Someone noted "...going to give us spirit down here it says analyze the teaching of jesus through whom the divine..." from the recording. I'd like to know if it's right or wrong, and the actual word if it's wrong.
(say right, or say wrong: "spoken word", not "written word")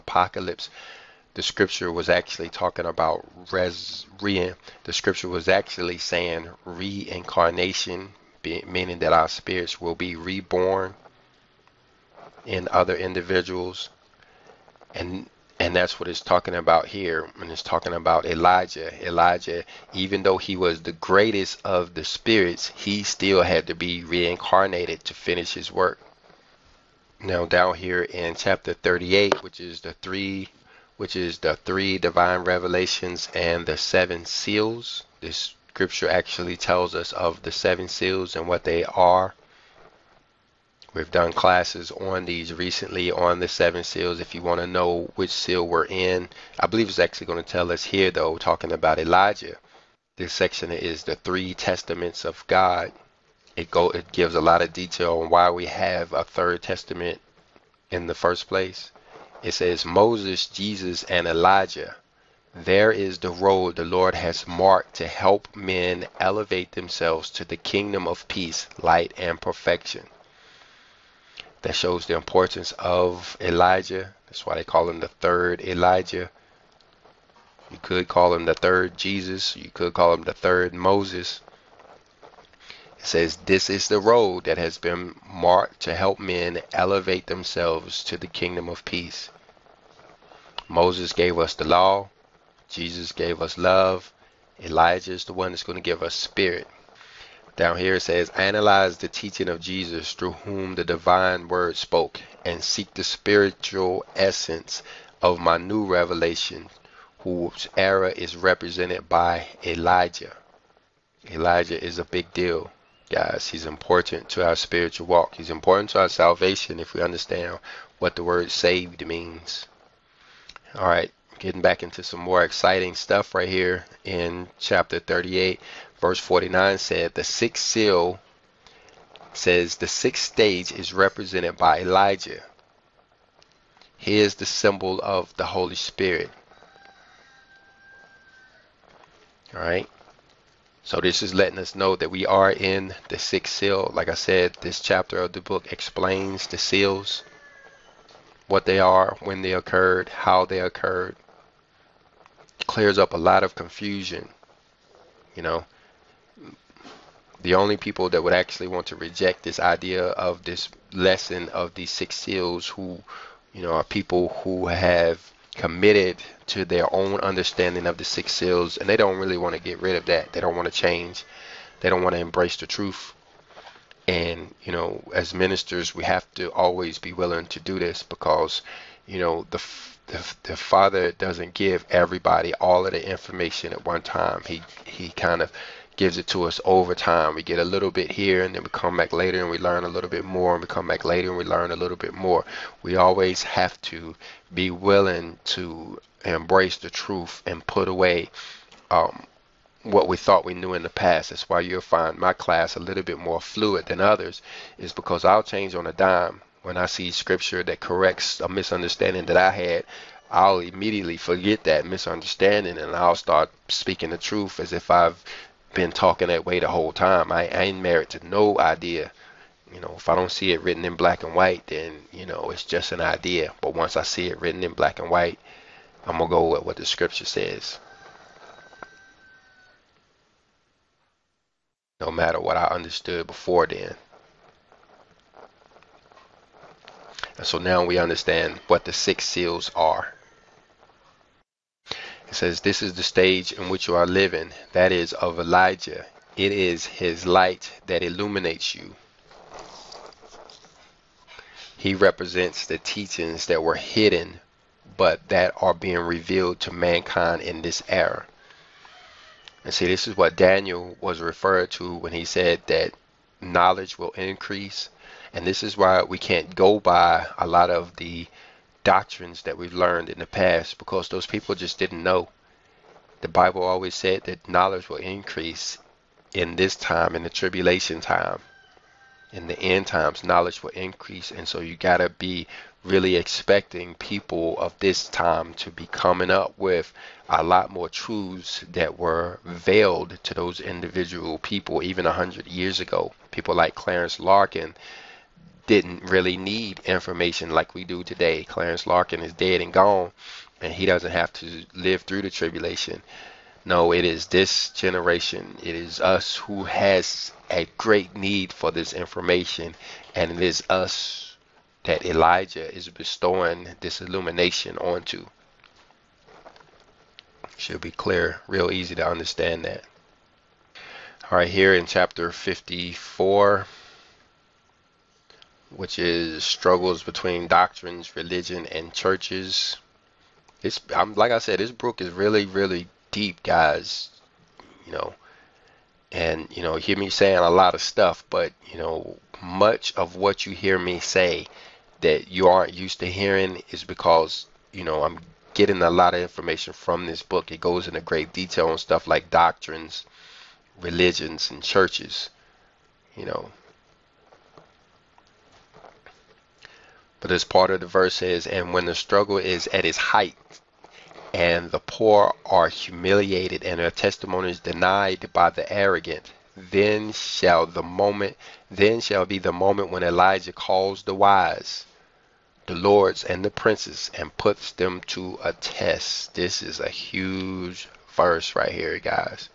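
right.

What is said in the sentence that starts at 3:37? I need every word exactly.
I, I ain't married to no idea.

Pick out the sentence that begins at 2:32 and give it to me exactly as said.
Clears up a lot of confusion.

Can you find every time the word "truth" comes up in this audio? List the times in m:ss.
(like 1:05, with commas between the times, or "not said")
2:52, 3:16, 3:34, 4:47.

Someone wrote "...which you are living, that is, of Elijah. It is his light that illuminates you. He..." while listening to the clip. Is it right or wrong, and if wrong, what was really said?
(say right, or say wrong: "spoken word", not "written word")
right.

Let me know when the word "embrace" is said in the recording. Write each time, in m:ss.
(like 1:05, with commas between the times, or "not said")
2:52, 3:16.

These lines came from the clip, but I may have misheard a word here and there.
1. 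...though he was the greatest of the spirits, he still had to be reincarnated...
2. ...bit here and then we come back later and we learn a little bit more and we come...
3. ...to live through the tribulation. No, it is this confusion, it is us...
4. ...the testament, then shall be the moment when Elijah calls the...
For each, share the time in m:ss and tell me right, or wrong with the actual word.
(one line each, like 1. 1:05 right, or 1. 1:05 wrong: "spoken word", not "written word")
1. 0:20 right
2. 3:07 right
3. 5:01 wrong: "generation", not "confusion"
4. 6:07 wrong: "moment", not "testament".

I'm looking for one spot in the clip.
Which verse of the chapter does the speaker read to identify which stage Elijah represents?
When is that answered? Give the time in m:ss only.
2:06.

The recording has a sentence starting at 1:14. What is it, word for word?
That's why they call him the third Elijah.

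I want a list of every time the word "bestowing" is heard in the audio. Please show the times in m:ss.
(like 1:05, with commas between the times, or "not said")
5:12.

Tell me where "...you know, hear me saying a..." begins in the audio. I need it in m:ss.
5:36.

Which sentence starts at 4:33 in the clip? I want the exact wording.
The Bible always said that knowledge will increase in this time, in the tribulation time, in the end times, knowledge will increase.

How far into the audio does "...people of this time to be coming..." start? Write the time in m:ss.
4:43.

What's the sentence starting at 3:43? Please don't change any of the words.
But once I see it written in black and white, I'm going to go with what the scripture says.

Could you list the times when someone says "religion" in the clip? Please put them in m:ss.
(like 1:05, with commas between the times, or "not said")
5:28, 5:50.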